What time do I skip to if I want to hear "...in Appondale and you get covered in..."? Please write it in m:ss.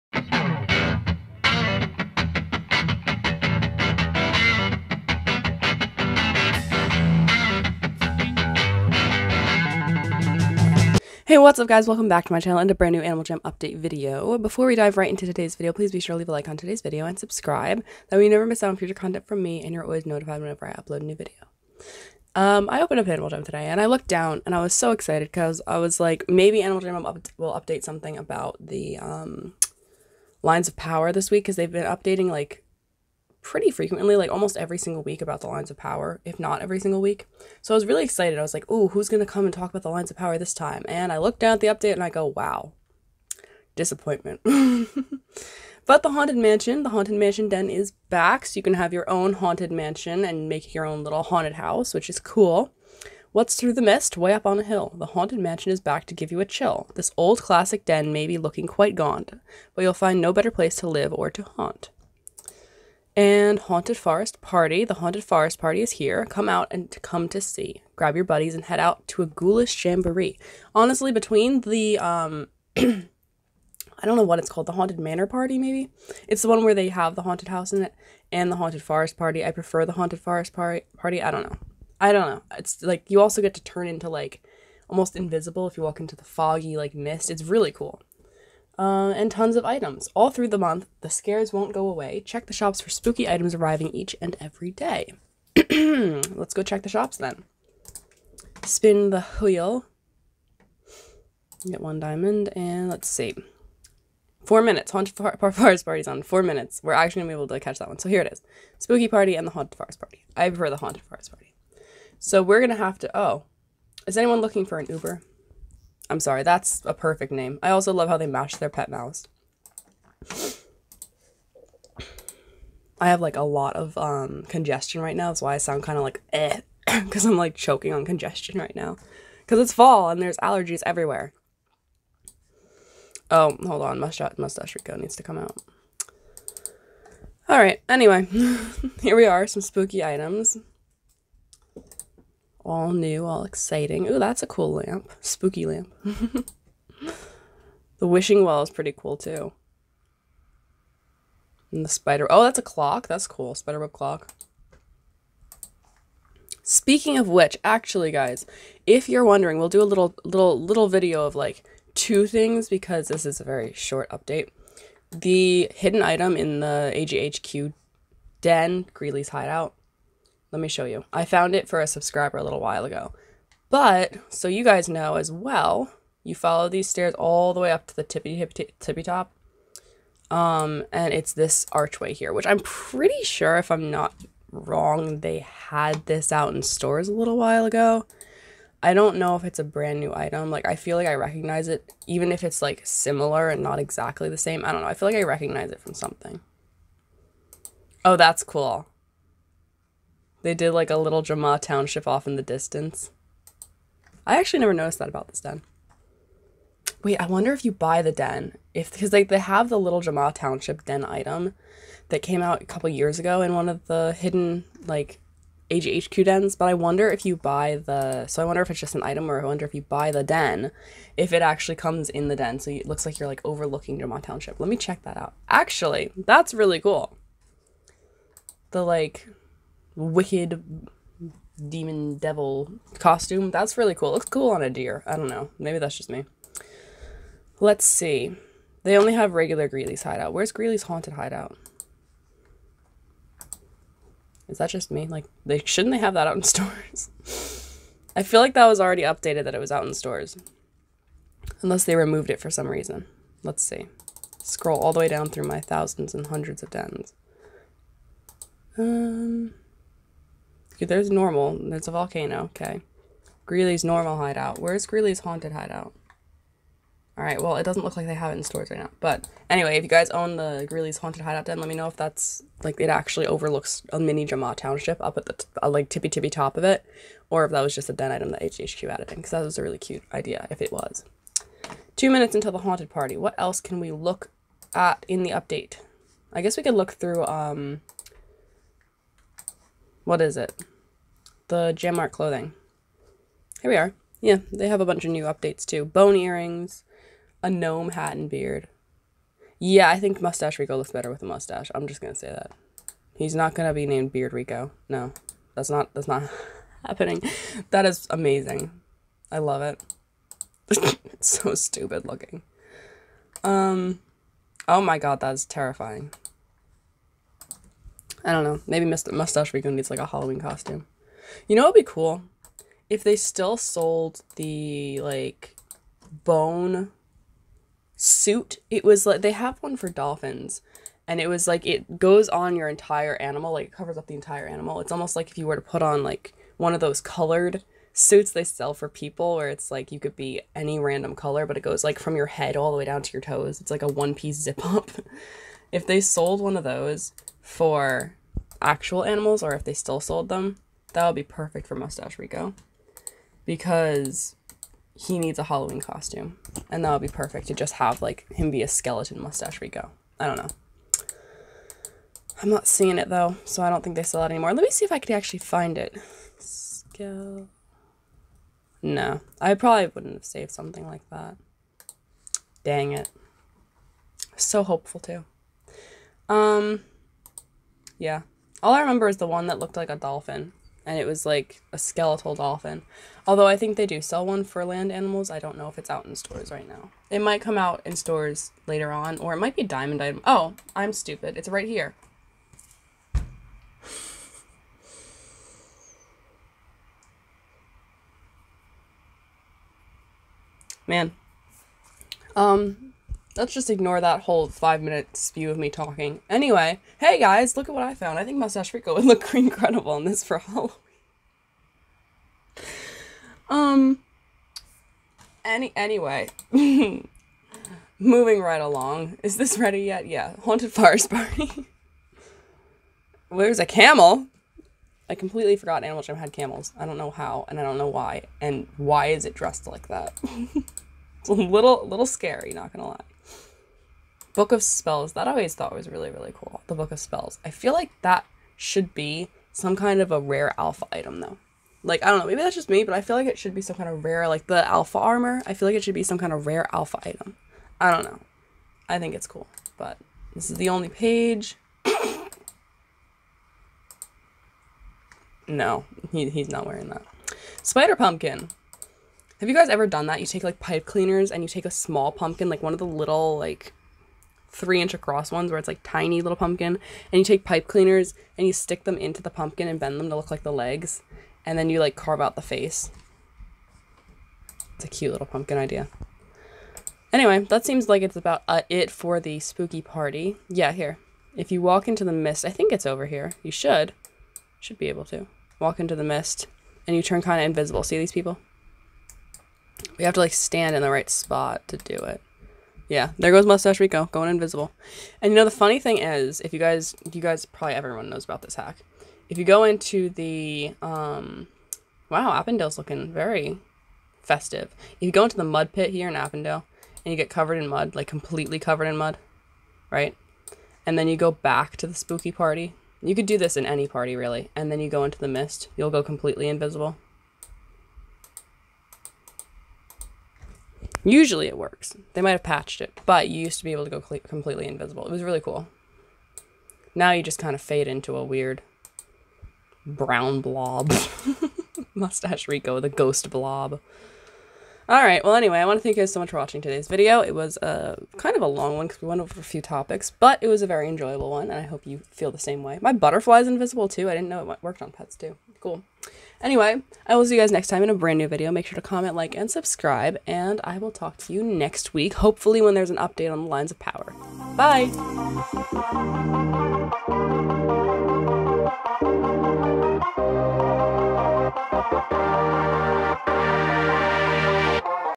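8:26.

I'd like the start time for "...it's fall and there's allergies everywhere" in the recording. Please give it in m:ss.
2:09.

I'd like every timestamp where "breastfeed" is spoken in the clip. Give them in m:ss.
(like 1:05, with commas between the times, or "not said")
not said.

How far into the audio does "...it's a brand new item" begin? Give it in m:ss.
3:09.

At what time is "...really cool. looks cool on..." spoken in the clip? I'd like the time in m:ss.
3:53.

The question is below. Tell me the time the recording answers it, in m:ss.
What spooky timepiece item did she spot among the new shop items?
2:33.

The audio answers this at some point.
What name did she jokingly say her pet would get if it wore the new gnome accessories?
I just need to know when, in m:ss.
5:04.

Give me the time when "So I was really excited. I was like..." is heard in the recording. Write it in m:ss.
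0:37.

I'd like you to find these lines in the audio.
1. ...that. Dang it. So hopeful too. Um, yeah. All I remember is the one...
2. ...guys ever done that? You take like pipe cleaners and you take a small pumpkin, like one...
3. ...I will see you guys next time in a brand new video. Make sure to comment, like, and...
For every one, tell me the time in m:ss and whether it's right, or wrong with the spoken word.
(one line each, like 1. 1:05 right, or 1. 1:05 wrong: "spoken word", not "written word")
1. 6:11 right
2. 7:39 right
3. 9:07 right.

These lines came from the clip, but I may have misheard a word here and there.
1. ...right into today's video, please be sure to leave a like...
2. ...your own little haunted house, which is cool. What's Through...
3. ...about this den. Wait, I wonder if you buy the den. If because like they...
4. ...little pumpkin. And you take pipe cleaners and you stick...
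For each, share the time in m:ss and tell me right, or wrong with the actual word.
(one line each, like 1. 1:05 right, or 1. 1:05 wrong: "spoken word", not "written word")
1. 0:14 right
2. 0:50 right
3. 3:25 right
4. 7:46 right.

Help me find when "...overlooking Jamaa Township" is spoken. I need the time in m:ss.
3:43.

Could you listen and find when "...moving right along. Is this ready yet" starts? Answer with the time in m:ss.
6:56.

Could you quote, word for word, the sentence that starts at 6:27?
It might come out in stores later on, or it might be diamond item.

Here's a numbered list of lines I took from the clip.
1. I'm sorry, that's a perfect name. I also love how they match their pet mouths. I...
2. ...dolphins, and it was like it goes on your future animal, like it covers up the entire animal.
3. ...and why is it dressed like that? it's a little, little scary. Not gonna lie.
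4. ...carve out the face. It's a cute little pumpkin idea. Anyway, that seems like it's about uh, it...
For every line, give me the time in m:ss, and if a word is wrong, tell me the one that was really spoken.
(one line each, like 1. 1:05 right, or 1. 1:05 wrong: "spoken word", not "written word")
1. 1:56 right
2. 5:29 wrong: "entire", not "future"
3. 7:08 right
4. 7:51 right.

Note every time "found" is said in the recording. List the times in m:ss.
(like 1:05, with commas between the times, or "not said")
2:51, 6:47.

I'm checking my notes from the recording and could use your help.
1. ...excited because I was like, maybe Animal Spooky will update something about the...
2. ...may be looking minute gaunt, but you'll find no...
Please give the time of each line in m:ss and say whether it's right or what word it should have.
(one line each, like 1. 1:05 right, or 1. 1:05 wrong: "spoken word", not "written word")
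1. 0:24 wrong: "Jam", not "Spooky"
2. 0:58 wrong: "quite", not "minute".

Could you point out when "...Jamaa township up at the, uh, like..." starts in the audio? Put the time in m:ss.
4:34.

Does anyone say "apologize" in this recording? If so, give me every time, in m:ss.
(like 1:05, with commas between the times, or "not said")
not said.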